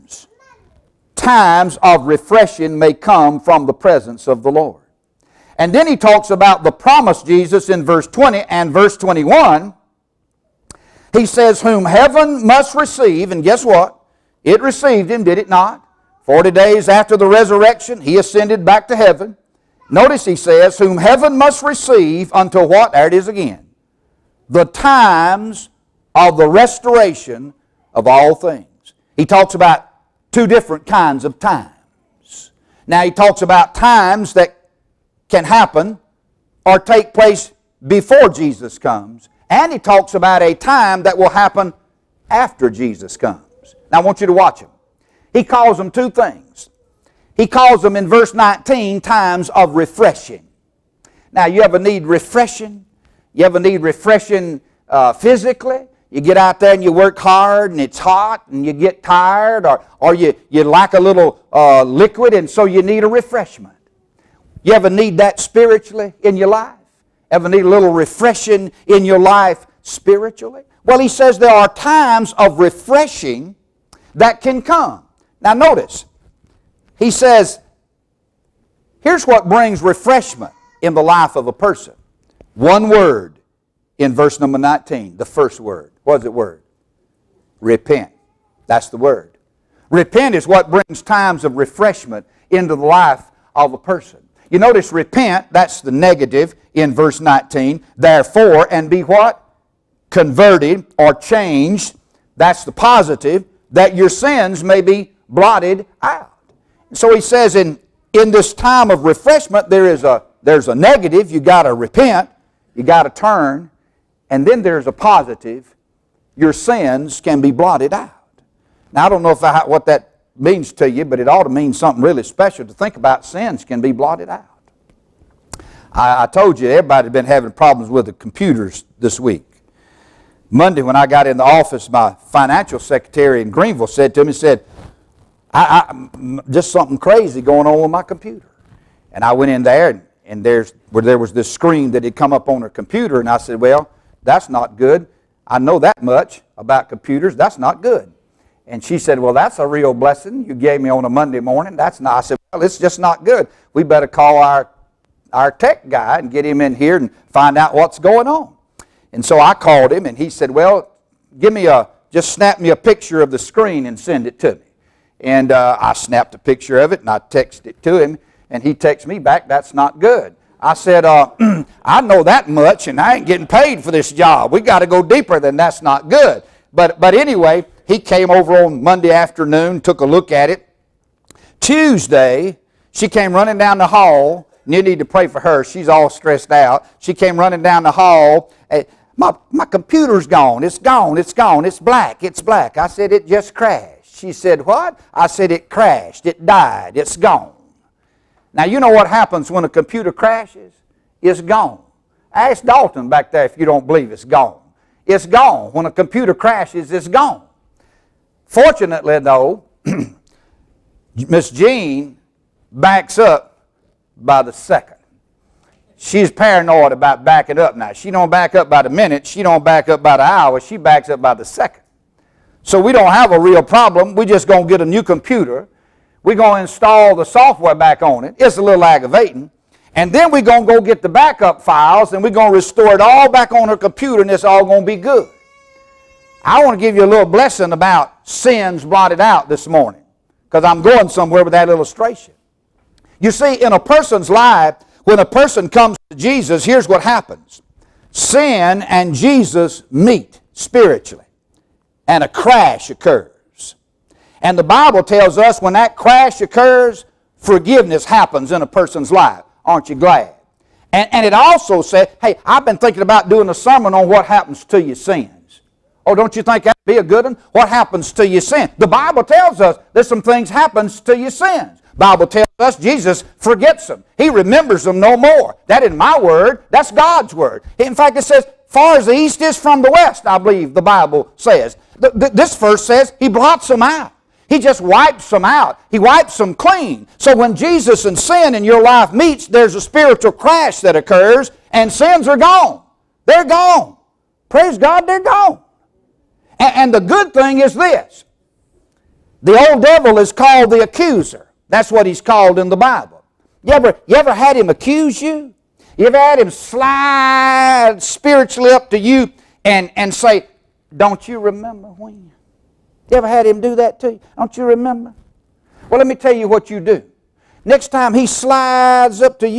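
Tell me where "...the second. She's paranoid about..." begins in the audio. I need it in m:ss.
3:34.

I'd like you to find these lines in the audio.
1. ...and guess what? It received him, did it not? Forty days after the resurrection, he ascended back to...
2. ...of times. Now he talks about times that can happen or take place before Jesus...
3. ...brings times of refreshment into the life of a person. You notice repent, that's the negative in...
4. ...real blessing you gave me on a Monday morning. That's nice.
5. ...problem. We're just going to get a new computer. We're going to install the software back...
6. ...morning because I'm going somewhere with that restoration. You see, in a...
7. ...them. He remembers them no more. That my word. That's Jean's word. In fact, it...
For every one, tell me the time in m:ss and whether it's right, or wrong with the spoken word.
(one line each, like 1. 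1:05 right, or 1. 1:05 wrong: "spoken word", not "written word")
1. 0:13 right
2. 0:31 right
3. 1:30 right
4. 2:29 right
5. 3:43 right
6. 3:59 wrong: "illustration", not "restoration"
7. 4:33 wrong: "God", not "Jean".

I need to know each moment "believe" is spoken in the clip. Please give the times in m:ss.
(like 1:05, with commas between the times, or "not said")
3:23, 4:40.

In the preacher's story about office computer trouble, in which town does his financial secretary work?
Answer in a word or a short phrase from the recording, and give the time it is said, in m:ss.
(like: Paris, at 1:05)
Greenville, at 2:13.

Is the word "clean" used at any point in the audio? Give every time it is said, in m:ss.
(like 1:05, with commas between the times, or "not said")
4:46.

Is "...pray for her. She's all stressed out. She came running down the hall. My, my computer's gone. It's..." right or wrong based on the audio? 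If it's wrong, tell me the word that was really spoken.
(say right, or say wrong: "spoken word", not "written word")
right.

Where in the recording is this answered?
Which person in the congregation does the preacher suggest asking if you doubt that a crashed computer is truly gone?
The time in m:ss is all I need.
3:22.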